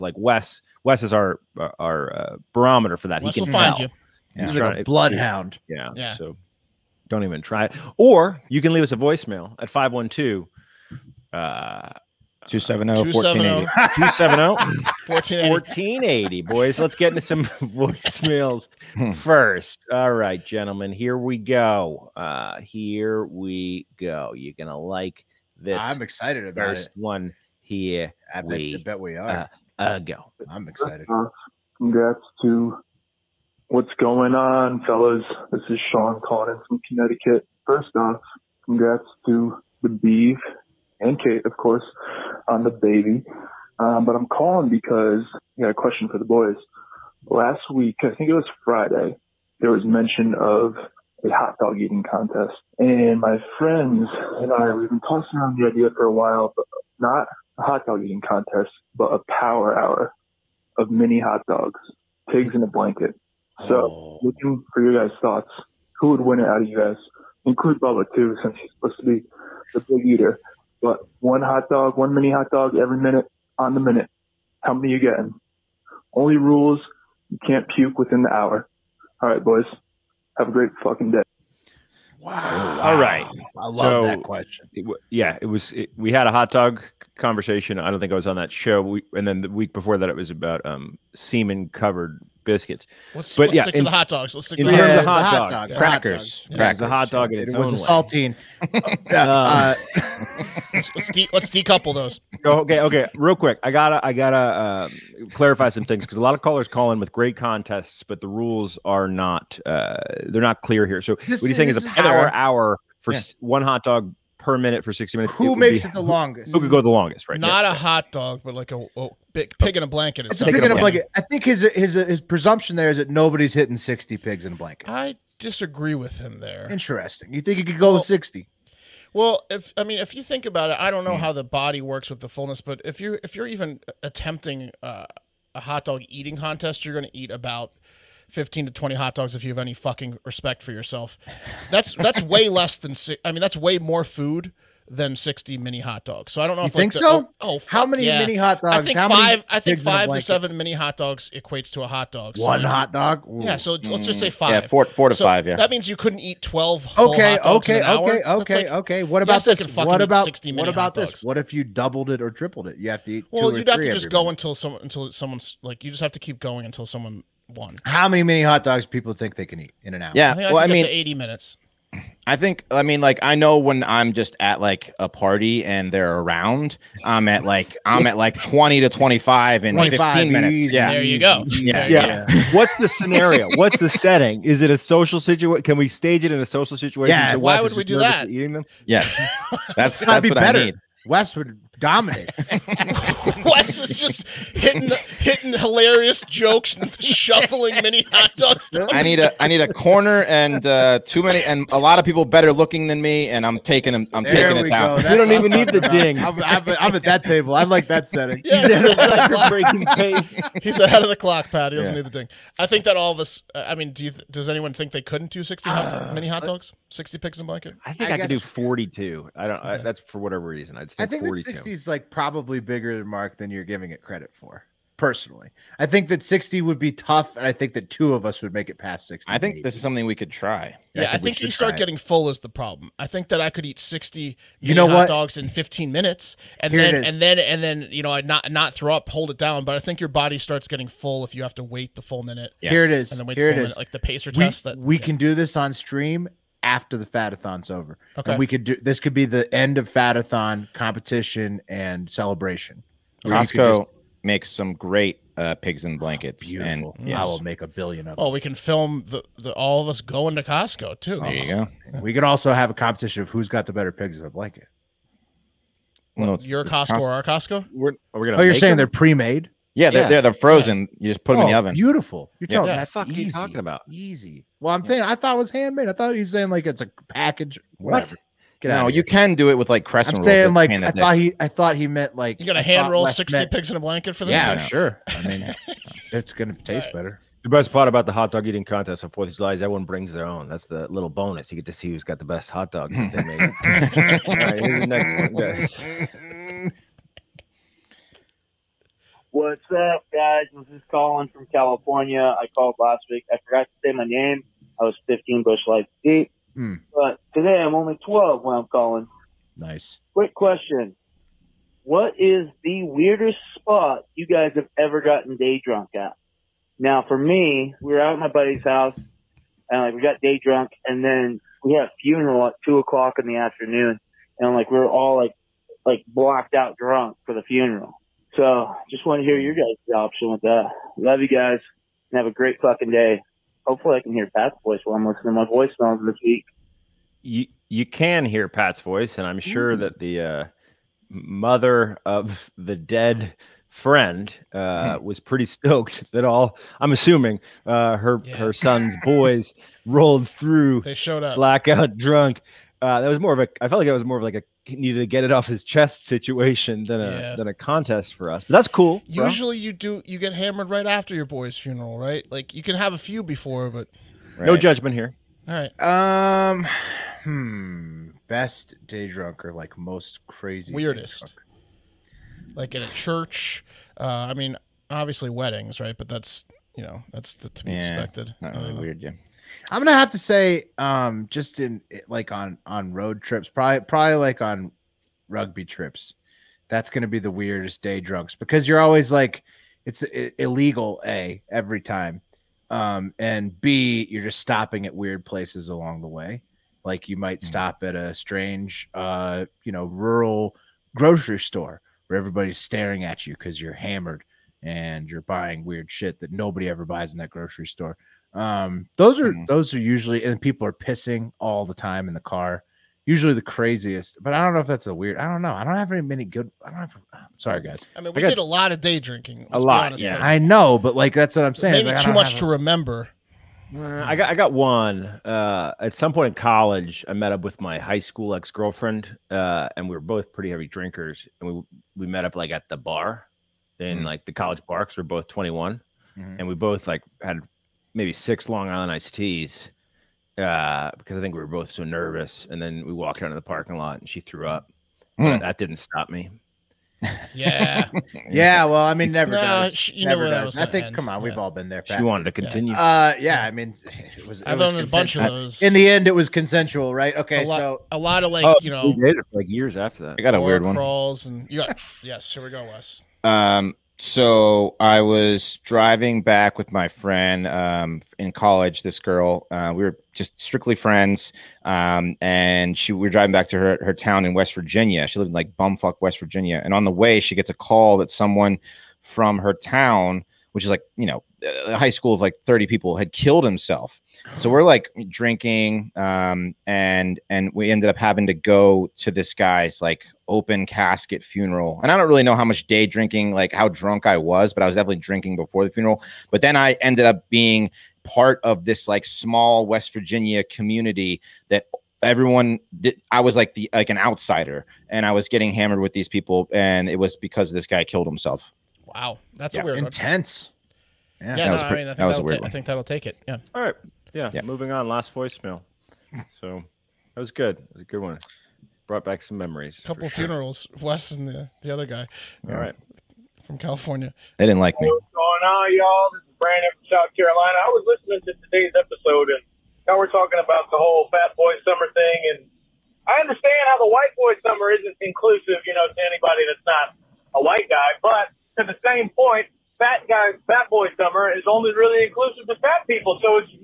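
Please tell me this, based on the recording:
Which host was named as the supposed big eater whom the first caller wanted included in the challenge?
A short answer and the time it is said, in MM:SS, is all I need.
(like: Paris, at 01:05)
Bubba, at 01:07.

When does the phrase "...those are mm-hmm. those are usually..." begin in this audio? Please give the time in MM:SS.
06:48.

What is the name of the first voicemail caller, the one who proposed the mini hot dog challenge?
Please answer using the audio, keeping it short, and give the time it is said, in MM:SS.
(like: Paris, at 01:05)
Sean, at 00:35.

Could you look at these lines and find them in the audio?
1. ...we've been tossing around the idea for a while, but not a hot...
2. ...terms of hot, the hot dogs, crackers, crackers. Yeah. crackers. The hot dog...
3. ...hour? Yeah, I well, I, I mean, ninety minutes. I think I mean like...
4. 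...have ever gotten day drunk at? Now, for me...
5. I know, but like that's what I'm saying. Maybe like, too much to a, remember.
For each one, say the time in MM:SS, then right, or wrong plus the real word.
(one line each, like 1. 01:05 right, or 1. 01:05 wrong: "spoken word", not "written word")
1. 00:54 right
2. 01:34 right
3. 02:50 wrong: "eighty", not "ninety"
4. 05:14 right
5. 07:00 right.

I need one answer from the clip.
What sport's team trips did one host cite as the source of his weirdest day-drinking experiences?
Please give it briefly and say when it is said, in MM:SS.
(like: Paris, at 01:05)
Rugby, at 06:25.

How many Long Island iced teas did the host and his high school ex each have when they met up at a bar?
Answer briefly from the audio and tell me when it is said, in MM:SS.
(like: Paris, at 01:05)
6, at 07:18.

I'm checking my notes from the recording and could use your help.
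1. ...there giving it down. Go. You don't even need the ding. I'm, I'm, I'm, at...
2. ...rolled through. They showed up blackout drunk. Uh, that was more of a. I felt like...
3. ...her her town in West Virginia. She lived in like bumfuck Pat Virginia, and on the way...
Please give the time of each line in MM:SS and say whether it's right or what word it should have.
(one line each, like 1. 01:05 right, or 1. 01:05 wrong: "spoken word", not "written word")
1. 03:24 wrong: "taking", not "giving"
2. 05:49 right
3. 07:53 wrong: "West", not "Pat".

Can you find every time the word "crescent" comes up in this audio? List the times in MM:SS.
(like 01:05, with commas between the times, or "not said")
04:39.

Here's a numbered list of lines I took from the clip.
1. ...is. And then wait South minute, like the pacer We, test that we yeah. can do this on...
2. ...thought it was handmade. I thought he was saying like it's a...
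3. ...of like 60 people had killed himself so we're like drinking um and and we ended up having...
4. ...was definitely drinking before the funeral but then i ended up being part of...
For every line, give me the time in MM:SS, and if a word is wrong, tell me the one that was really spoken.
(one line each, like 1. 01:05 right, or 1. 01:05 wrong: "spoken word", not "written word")
1. 04:02 wrong: "Here", not "South"
2. 04:35 right
3. 08:02 wrong: "30", not "60"
4. 08:14 right.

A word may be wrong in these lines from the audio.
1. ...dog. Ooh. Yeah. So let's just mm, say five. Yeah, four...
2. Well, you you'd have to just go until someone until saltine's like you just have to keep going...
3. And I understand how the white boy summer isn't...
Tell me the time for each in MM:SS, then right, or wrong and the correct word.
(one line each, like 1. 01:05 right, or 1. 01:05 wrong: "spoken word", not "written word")
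1. 02:32 right
2. 02:43 wrong: "someone", not "saltine"
3. 08:52 right.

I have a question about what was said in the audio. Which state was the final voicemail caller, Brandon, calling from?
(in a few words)
South Carolina.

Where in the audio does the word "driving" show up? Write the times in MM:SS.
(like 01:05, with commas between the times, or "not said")
07:45, 07:53.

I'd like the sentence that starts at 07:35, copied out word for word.
In the end, it was consensual, right?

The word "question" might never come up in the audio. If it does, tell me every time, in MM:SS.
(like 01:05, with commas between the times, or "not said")
00:45, 01:24, 05:10.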